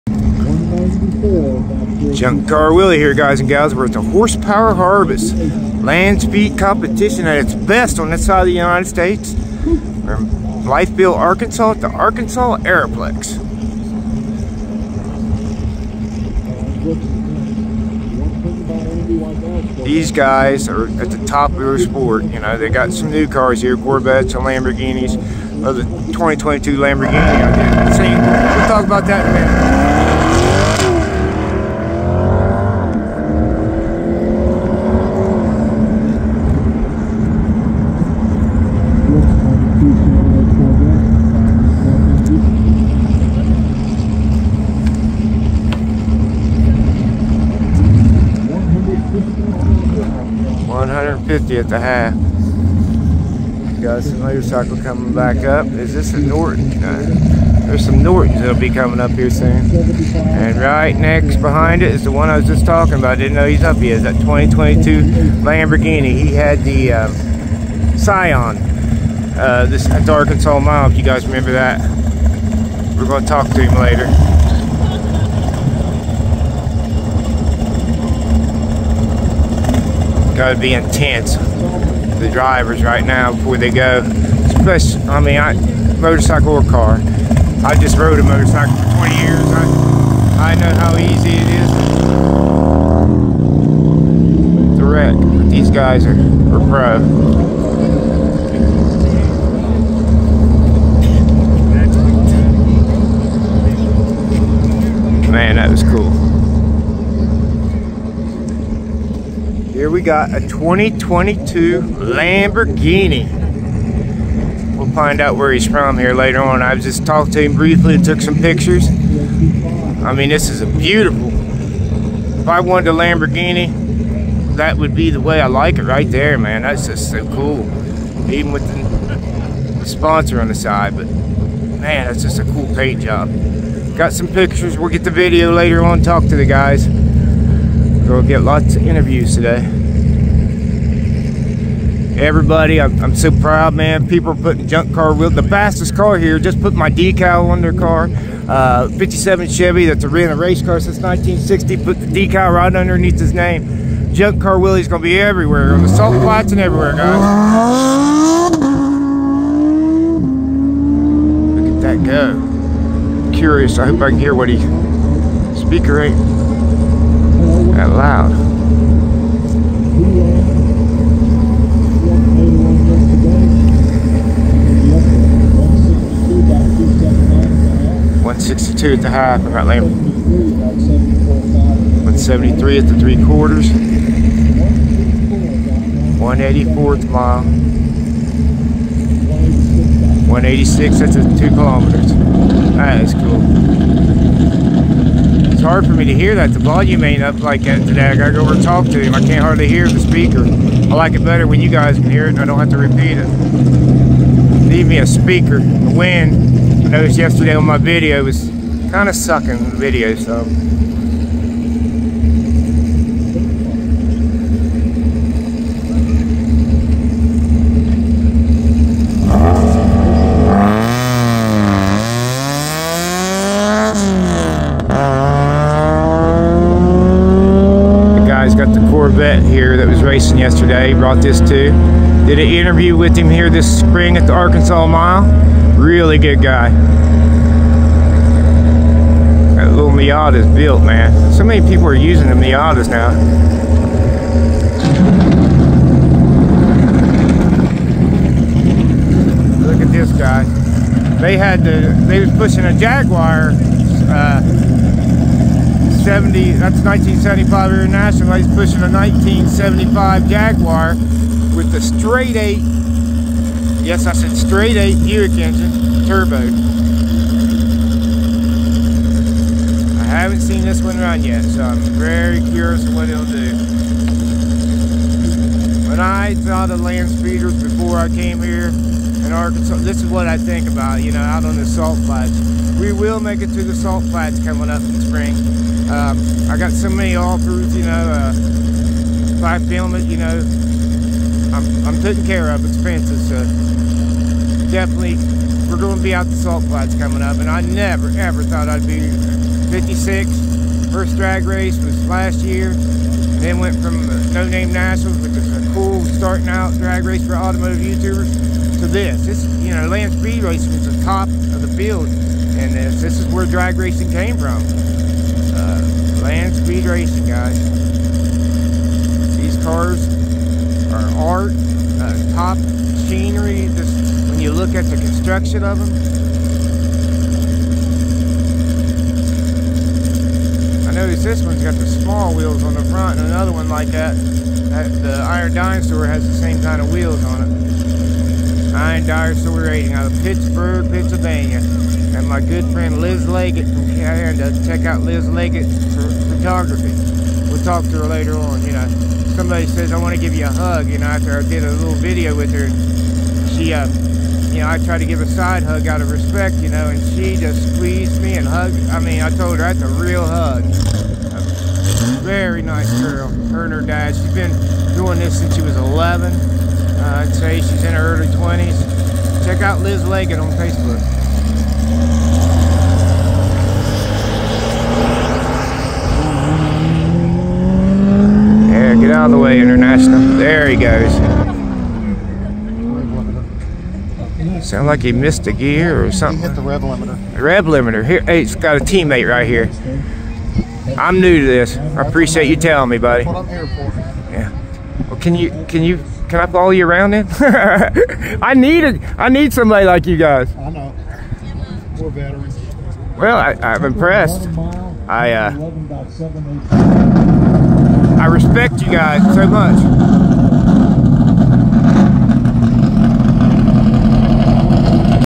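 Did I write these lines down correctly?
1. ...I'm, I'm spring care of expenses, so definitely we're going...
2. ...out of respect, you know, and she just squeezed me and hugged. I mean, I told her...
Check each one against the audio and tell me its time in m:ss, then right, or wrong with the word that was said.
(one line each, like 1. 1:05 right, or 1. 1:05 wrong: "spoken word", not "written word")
1. 4:51 wrong: "taking", not "spring"
2. 5:55 right.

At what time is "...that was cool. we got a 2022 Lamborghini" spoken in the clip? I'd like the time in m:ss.
1:45.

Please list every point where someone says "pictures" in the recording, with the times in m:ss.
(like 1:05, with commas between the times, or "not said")
1:58, 2:14.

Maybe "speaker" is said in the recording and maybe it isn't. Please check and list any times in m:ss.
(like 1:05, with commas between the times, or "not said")
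2:45, 3:19, 3:25.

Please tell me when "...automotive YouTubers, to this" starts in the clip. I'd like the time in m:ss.
5:07.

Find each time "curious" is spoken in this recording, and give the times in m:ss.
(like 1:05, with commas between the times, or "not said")
2:43, 4:32.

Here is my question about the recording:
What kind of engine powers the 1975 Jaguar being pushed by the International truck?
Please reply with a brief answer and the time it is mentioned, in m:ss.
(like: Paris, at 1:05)
straight eight Buick, at 4:24.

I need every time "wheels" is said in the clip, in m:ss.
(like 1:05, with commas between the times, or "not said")
2:25, 5:32, 5:36.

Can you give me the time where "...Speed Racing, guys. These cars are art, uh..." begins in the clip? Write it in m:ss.
5:16.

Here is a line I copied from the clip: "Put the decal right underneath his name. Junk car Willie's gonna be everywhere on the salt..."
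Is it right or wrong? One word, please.
right.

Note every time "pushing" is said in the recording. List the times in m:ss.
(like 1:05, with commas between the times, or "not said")
4:12, 4:18.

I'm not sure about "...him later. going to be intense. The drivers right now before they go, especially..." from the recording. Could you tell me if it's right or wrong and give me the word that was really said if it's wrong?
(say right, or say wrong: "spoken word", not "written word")
right.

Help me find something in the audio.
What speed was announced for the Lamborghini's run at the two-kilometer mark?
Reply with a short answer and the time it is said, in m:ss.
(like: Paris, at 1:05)
186, at 3:07.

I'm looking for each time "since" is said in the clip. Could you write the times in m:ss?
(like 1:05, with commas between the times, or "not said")
2:30, 6:05.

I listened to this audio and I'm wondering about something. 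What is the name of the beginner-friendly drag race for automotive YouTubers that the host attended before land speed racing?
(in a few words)
No Name Nationals.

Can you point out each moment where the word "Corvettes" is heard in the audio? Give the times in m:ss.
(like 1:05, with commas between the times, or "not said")
0:23, 3:48.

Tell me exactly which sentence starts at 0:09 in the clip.
from are Blytheville, Arkansas at the Arkansas Aeroplex.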